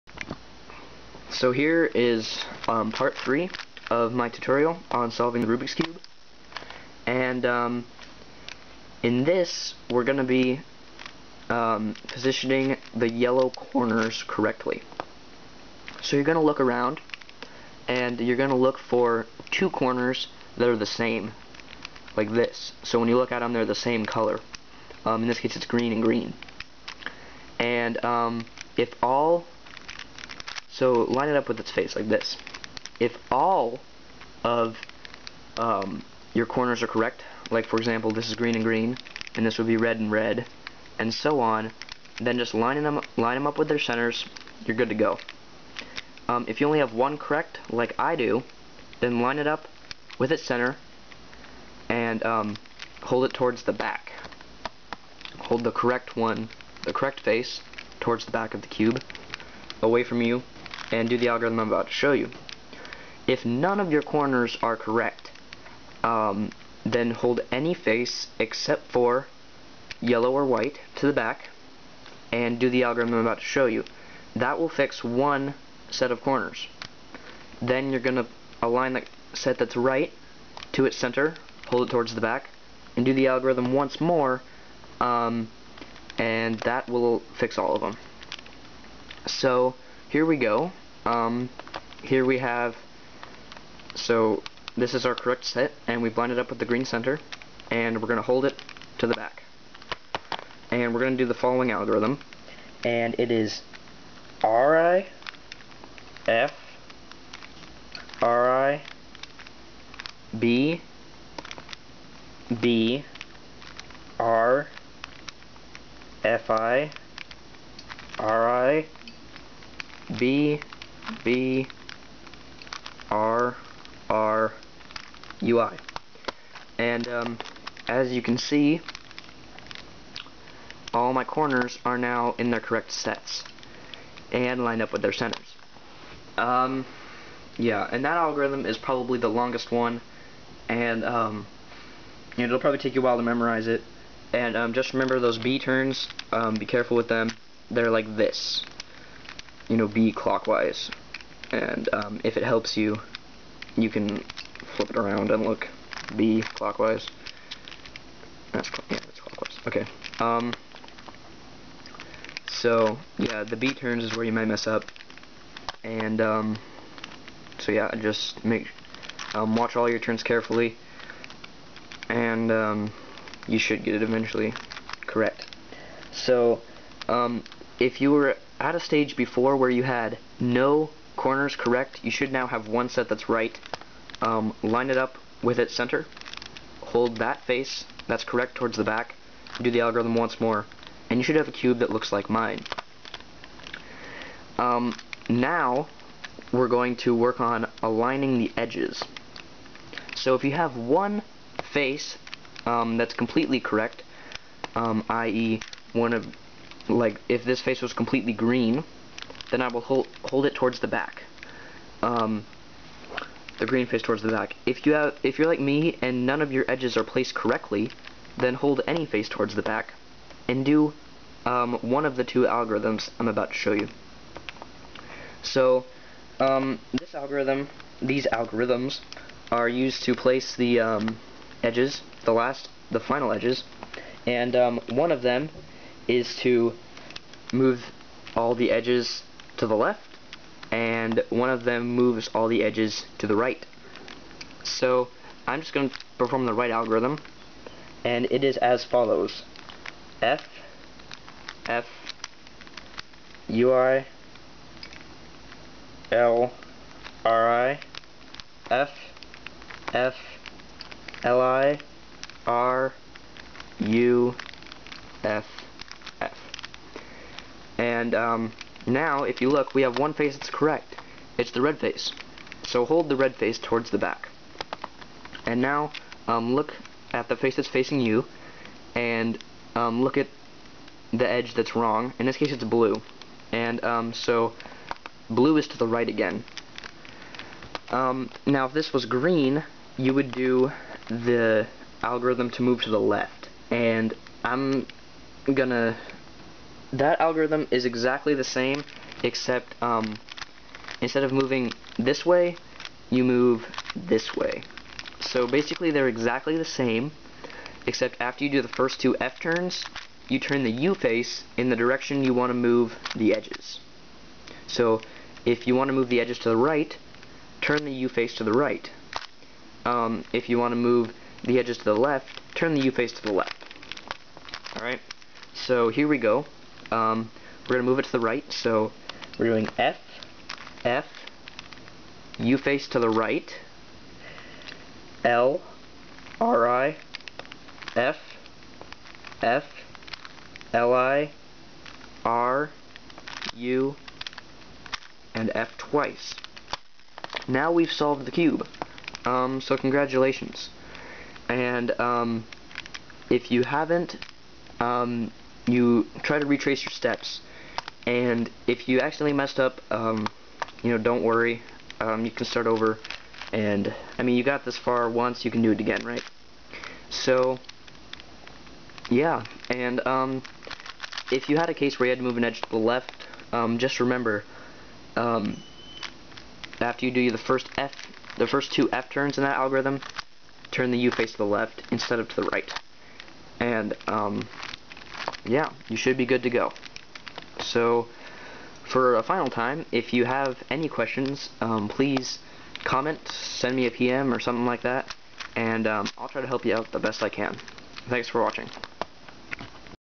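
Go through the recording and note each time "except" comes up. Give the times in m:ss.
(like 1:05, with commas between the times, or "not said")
1:08, 4:59, 5:07.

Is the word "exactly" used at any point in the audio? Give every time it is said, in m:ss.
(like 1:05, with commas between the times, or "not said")
4:57, 5:06.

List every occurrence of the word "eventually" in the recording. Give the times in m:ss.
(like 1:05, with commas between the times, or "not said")
2:54.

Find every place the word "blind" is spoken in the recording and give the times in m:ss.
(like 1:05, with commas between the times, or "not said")
1:36.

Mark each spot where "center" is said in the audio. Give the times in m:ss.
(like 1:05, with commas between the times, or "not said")
0:43, 0:50, 1:20, 1:36, 2:15, 3:05.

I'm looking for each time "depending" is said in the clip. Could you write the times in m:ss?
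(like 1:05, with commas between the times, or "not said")
not said.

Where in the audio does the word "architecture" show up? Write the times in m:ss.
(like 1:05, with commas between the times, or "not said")
not said.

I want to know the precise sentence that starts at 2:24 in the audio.
And um, just remember those B turns, um, be careful with them.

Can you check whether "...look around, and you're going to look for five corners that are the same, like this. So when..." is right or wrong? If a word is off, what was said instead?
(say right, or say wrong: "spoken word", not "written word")
wrong: "two", not "five".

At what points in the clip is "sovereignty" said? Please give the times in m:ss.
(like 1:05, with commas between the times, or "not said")
not said.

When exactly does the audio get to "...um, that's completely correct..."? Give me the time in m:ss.
3:22.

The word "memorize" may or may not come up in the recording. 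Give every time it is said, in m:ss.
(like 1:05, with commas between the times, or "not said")
2:23.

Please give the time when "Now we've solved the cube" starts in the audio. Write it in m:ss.
5:47.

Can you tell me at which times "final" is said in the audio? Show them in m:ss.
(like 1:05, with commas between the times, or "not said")
3:52, 6:29.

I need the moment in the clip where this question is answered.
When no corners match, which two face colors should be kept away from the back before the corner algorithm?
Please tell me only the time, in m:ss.
1:10.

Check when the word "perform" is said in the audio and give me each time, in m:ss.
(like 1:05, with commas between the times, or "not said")
4:06.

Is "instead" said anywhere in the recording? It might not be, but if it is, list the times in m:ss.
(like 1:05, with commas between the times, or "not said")
5:00, 6:21.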